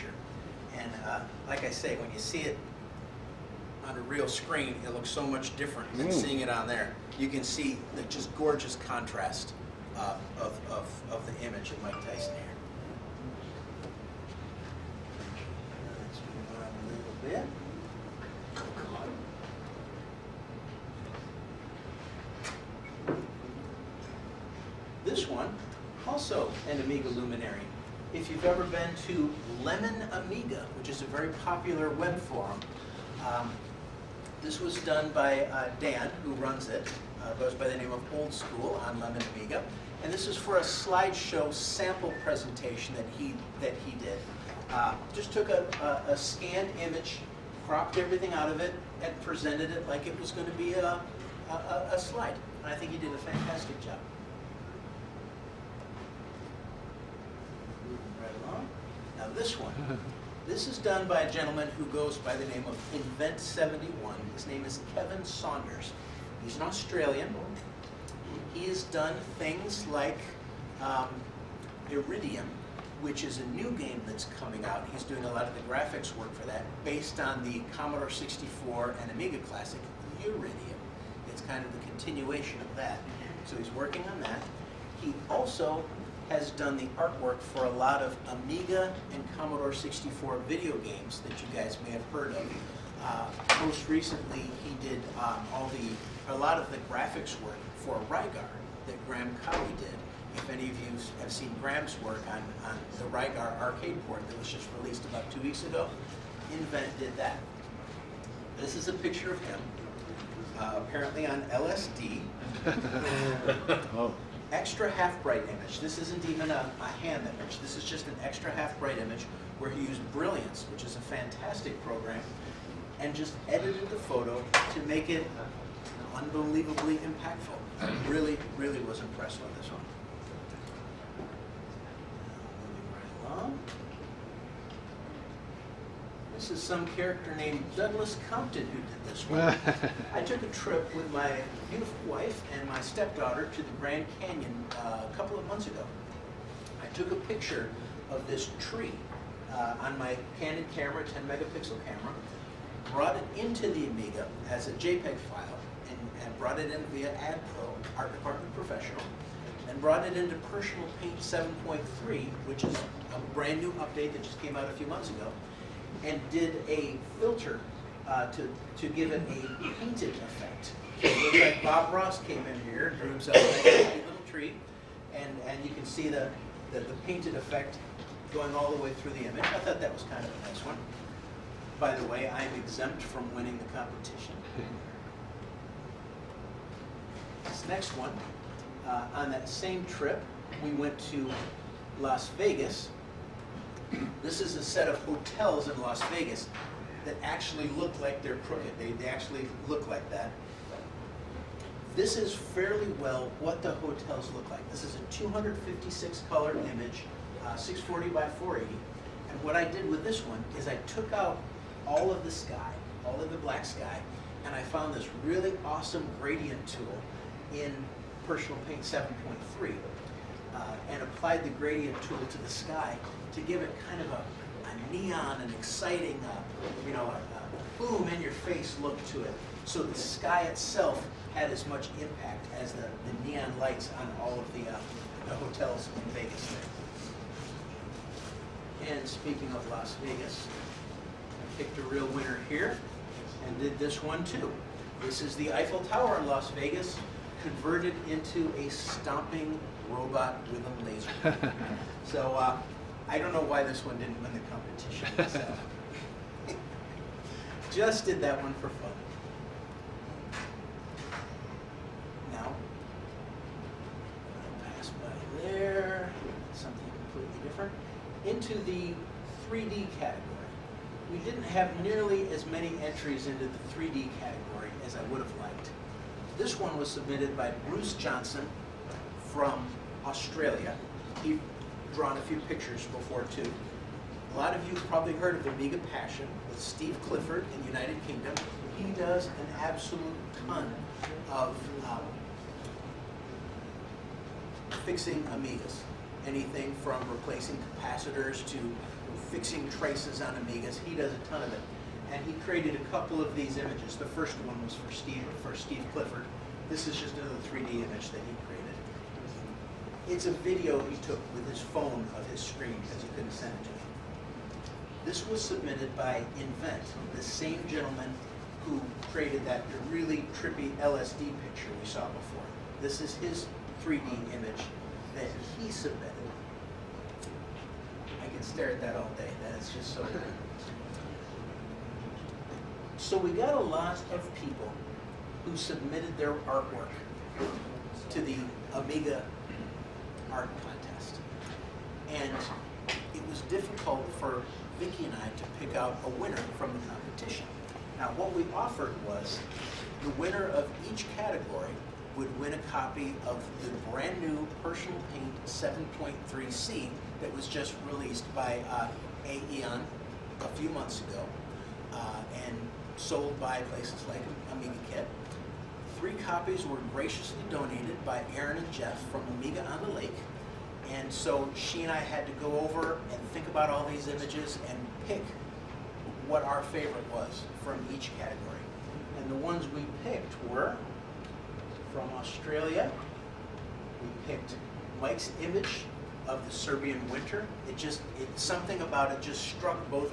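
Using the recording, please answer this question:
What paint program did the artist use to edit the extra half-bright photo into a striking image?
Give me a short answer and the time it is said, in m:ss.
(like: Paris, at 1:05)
Brilliance, at 2:00.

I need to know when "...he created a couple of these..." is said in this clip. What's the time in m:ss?
5:02.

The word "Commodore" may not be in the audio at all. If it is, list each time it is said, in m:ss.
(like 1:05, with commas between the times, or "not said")
1:17, 1:29.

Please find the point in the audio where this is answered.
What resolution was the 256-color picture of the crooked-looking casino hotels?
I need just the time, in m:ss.
3:27.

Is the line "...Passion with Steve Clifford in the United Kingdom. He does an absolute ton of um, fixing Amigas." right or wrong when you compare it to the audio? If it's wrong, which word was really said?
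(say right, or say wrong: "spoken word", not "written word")
right.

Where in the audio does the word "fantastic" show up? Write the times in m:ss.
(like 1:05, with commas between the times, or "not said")
0:53, 2:00.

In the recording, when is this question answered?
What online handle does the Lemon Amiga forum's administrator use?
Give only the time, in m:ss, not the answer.
0:38.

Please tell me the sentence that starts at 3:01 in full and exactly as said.
By the way, I'm exempt from winning the competition.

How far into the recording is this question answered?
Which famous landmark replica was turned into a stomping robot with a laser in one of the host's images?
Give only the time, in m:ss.
4:05.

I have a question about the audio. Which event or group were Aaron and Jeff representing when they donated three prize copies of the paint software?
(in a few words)
Amiga on the Lake.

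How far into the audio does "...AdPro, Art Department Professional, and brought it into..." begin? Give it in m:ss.
2:37.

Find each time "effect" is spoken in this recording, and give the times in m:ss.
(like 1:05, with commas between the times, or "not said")
2:50, 2:57.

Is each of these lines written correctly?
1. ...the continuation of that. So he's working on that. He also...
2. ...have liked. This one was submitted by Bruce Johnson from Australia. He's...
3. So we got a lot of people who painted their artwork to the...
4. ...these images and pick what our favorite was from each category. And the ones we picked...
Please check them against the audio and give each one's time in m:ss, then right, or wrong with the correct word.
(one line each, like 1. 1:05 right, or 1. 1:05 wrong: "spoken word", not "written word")
1. 1:21 right
2. 4:35 right
3. 5:33 wrong: "submitted", not "painted"
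4. 6:13 right.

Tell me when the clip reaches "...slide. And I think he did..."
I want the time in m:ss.
0:51.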